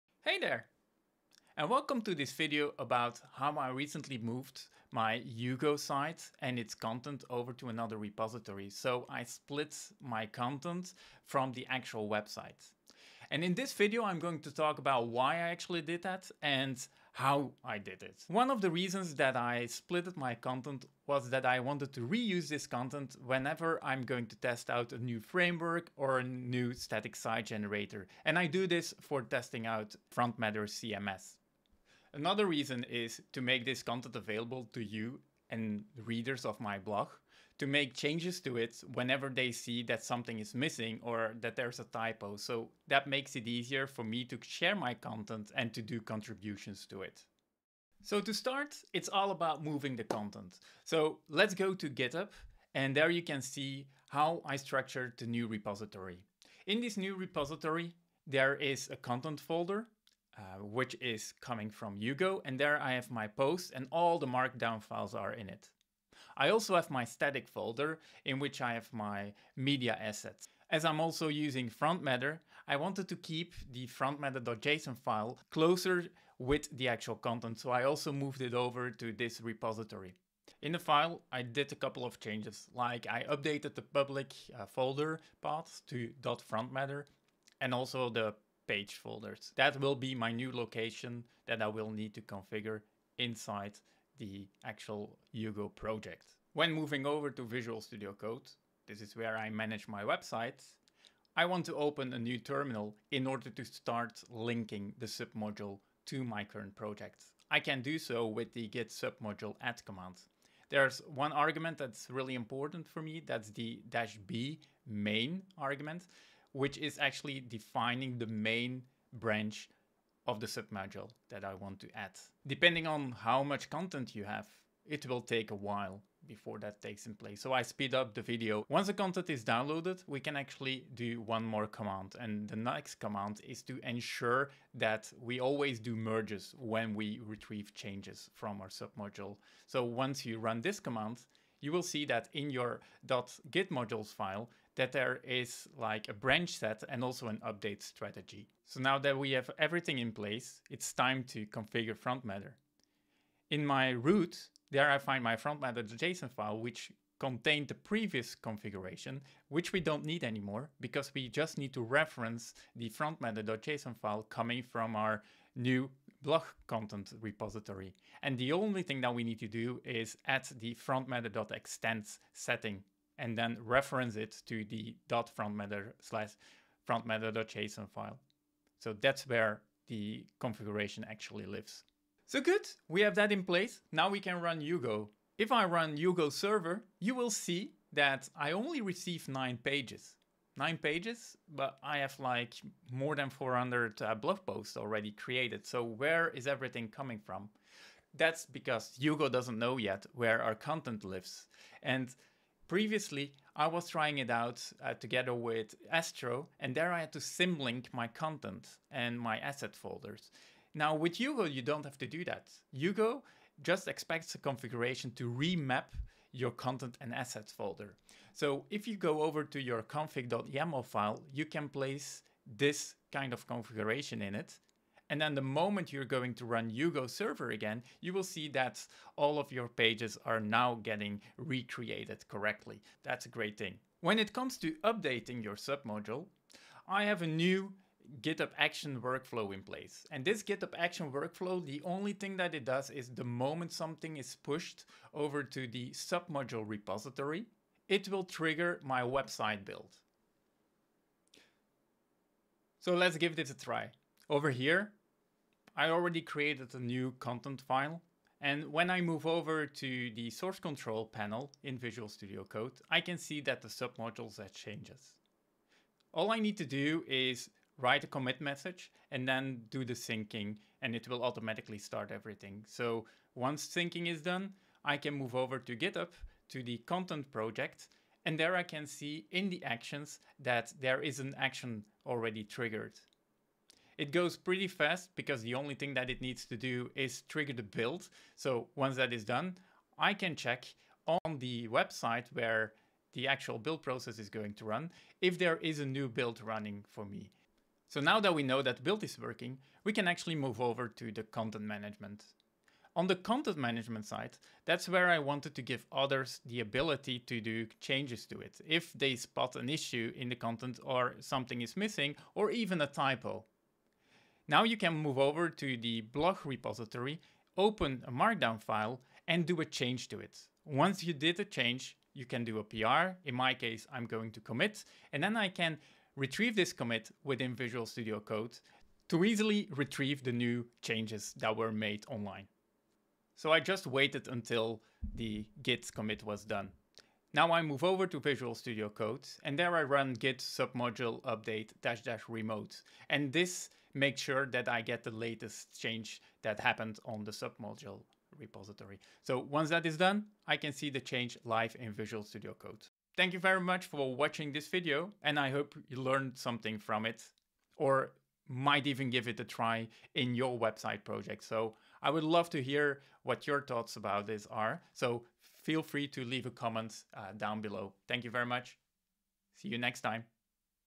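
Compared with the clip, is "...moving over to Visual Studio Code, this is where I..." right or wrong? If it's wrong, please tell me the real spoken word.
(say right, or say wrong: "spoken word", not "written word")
right.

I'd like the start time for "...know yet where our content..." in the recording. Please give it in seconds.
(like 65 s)
199 s.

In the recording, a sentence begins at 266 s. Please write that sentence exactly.
All I need to do is write a commit message and then do the syncing and it will automatically start everything.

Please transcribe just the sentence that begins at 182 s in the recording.
So good, we have that in place.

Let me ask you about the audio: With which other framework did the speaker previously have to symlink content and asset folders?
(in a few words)
Astro.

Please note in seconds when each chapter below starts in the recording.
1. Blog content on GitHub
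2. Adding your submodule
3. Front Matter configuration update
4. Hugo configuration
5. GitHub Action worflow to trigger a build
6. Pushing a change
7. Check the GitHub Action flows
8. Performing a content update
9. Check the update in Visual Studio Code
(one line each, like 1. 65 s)
1. 47 s
2. 96 s
3. 148 s
4. 185 s
5. 239 s
6. 251 s
7. 280 s
8. 297 s
9. 328 s.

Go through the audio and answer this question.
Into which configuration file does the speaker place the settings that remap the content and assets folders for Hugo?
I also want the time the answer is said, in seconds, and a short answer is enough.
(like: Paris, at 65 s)
config.yaml, at 219 s.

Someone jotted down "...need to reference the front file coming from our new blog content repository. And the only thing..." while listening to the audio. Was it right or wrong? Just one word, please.
right.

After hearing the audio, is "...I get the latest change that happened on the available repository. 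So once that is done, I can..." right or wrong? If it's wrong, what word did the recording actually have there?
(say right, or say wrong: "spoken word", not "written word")
wrong: "submodule", not "available".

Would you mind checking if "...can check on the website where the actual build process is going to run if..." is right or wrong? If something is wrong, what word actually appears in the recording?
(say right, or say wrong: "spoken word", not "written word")
right.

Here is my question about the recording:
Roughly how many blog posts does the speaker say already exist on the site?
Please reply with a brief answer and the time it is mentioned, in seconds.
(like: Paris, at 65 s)
more than 400, at 192 s.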